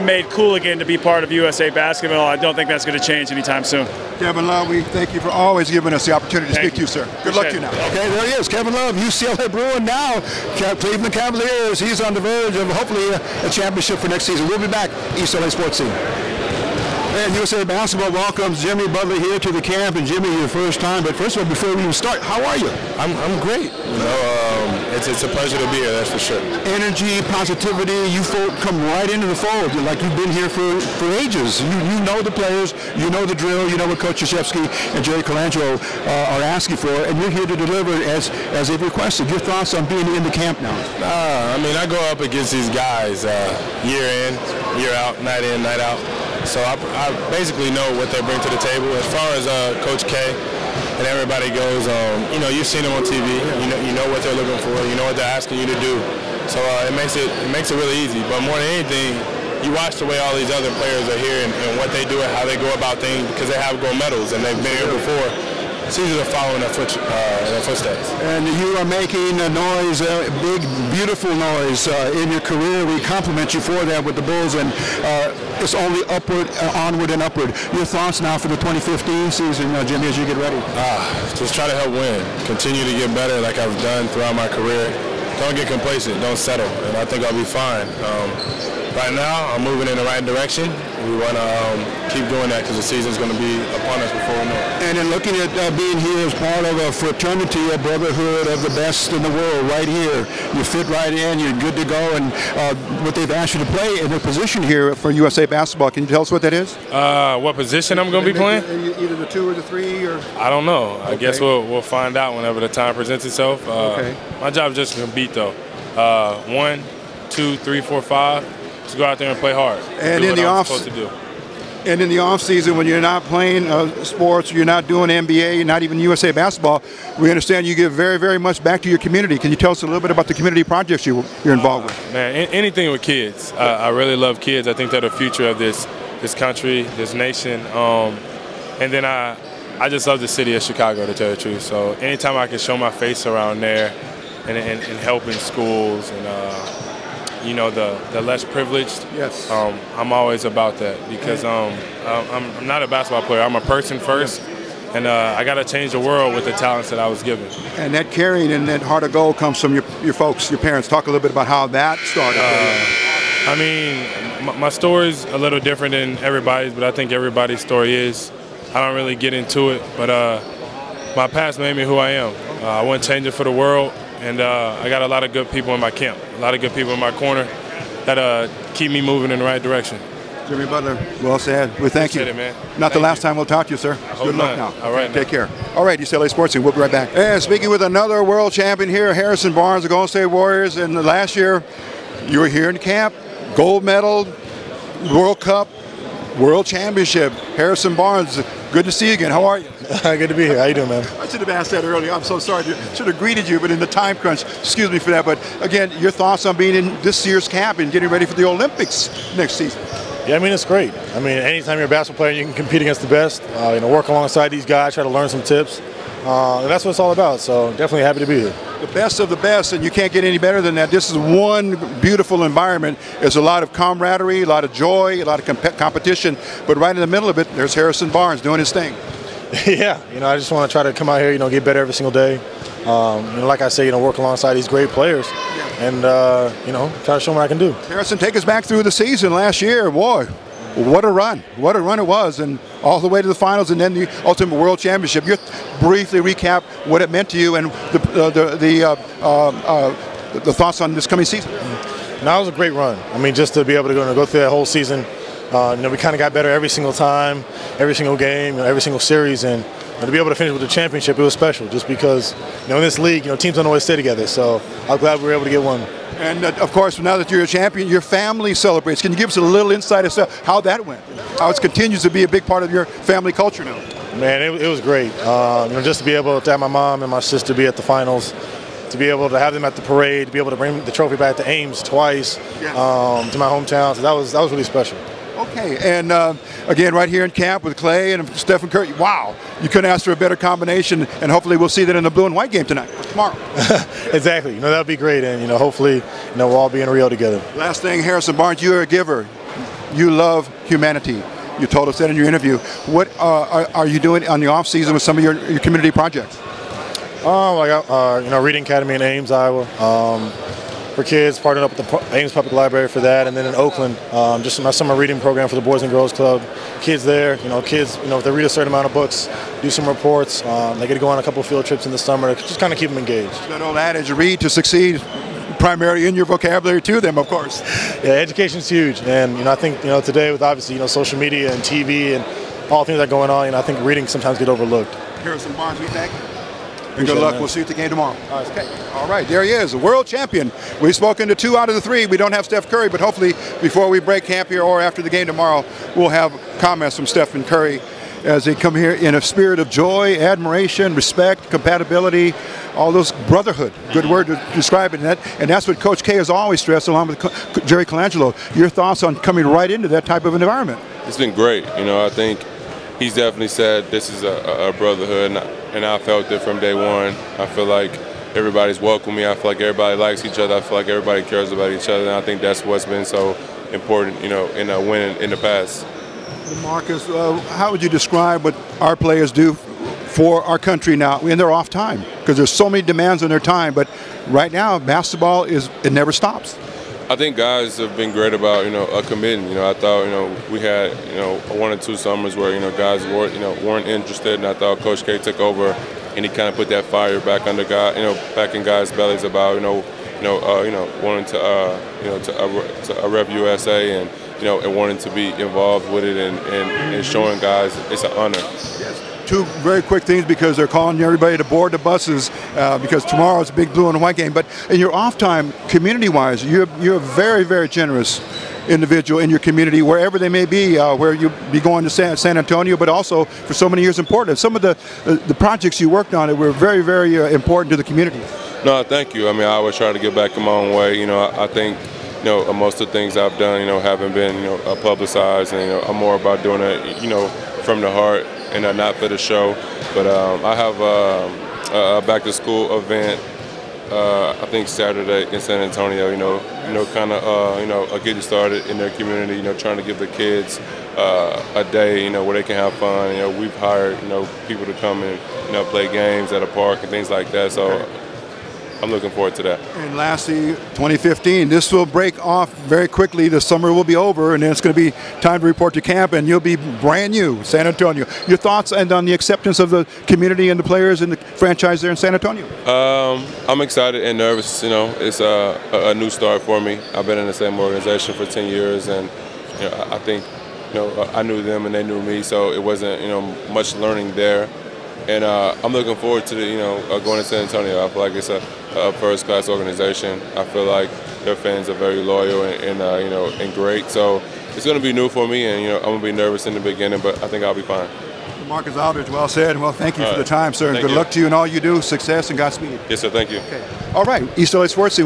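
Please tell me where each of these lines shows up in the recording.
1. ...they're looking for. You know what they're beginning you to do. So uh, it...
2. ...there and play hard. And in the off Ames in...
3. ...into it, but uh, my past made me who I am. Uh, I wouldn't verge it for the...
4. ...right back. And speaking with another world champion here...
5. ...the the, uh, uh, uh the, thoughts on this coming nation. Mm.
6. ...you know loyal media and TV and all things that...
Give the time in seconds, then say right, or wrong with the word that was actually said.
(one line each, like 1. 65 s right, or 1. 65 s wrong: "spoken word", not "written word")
1. 54 s wrong: "asking", not "beginning"
2. 119 s wrong: "And", not "Ames"
3. 169 s wrong: "change", not "verge"
4. 186 s right
5. 248 s wrong: "season", not "nation"
6. 330 s wrong: "social", not "loyal".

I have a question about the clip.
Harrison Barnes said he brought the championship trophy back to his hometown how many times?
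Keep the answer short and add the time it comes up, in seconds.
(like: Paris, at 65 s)
2, at 281 s.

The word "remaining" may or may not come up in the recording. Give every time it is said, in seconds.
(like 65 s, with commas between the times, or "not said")
not said.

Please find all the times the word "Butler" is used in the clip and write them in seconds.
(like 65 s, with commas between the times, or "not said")
18 s, 180 s.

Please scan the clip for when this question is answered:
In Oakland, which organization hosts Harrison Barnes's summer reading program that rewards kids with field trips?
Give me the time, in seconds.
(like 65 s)
315 s.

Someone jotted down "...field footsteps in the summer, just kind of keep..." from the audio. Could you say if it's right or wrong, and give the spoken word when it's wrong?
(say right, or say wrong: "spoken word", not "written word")
wrong: "trips", not "footsteps".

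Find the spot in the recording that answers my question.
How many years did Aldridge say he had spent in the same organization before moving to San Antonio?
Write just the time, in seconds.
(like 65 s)
478 s.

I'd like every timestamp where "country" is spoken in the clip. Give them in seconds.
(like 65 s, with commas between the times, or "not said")
136 s, 380 s.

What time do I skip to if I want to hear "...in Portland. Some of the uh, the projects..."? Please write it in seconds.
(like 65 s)
423 s.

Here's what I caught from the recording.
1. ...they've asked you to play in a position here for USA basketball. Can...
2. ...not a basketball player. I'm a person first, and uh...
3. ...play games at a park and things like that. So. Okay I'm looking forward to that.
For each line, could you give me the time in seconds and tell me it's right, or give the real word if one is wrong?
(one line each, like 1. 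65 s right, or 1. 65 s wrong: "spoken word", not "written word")
1. 103 s right
2. 152 s right
3. 455 s right.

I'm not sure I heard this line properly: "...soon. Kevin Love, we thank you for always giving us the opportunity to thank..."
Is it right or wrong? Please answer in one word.
right.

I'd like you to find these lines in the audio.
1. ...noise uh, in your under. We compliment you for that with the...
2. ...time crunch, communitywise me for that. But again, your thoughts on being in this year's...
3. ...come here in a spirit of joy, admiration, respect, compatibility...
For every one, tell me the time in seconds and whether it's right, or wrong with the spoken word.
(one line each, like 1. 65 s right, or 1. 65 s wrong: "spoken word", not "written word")
1. 71 s wrong: "career", not "under"
2. 203 s wrong: "excuse", not "communitywise"
3. 348 s right.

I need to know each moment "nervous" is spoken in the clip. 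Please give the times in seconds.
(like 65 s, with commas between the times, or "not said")
474 s, 496 s.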